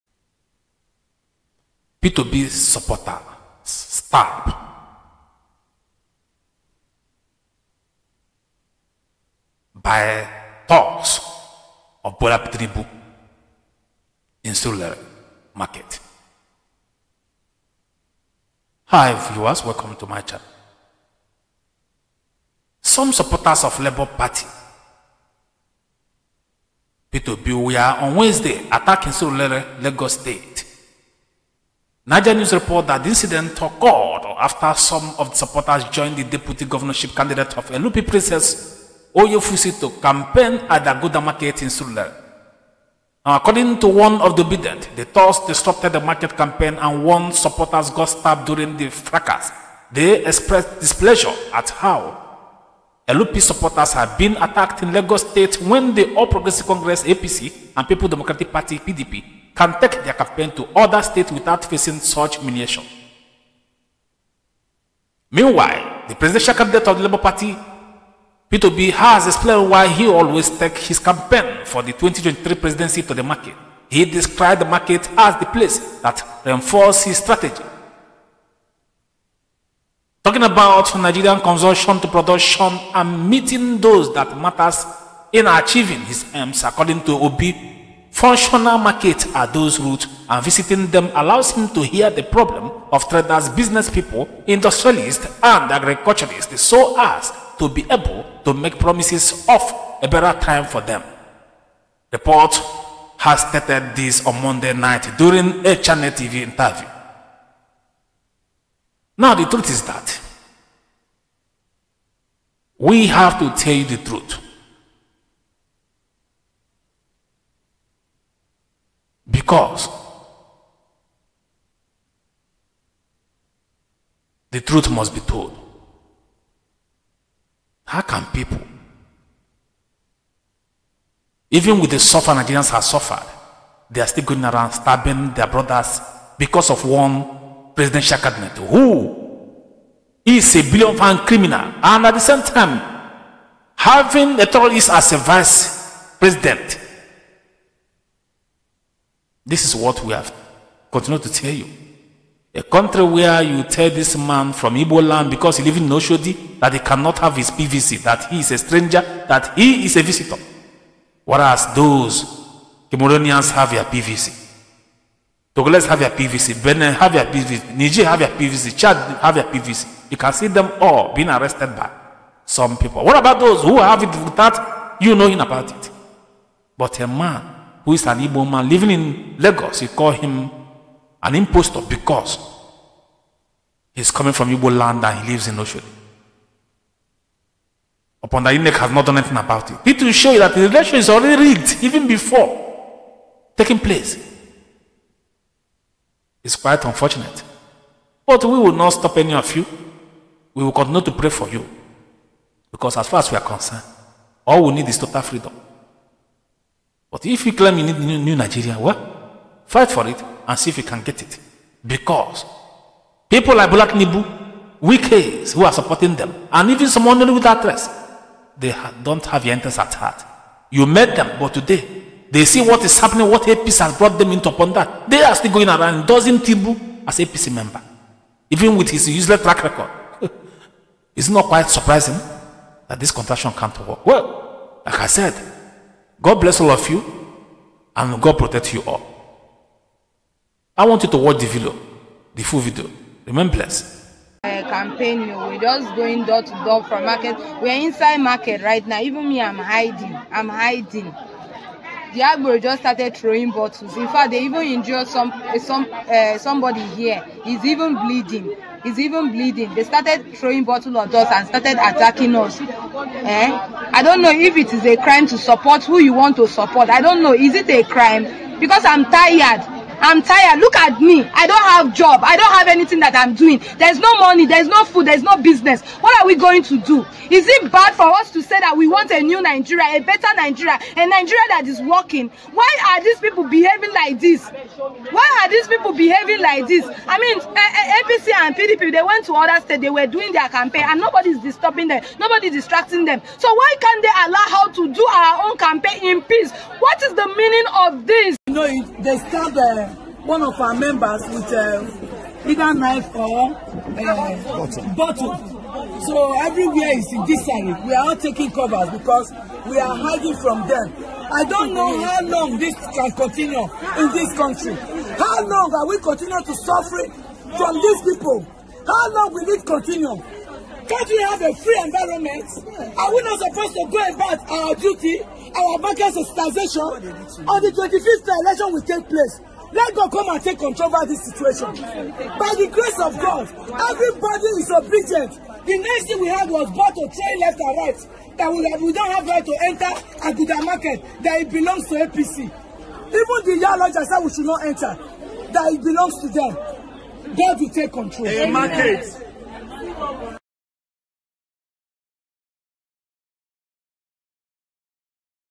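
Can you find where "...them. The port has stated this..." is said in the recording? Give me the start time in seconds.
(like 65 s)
100 s.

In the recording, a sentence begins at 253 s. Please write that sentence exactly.
In fact, they even injured some eh, some uh, somebody here.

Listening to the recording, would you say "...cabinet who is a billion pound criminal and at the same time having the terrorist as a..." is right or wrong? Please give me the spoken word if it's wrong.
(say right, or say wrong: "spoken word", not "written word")
right.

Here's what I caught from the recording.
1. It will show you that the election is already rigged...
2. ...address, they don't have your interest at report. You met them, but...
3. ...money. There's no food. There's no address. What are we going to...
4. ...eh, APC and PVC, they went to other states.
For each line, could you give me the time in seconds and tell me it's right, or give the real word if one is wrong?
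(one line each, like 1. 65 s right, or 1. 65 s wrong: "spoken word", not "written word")
1. 189 s right
2. 217 s wrong: "heart", not "report"
3. 274 s wrong: "business", not "address"
4. 287 s wrong: "PDP", not "PVC".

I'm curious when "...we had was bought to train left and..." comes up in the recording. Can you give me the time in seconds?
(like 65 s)
336 s.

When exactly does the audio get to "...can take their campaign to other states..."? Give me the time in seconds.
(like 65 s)
59 s.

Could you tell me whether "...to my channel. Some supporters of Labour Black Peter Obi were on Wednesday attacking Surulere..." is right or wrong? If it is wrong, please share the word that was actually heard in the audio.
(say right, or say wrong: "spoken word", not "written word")
wrong: "Party", not "Black".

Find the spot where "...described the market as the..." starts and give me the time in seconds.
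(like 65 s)
74 s.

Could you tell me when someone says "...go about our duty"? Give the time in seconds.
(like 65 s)
323 s.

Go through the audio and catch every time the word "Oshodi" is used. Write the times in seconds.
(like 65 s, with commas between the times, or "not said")
155 s, 185 s.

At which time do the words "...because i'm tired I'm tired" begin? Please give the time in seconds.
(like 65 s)
268 s.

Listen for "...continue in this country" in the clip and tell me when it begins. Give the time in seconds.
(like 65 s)
313 s.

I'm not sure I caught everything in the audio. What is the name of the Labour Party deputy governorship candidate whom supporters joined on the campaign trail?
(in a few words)
Princess Oyefusi.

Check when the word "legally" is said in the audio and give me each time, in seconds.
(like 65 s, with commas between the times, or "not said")
not said.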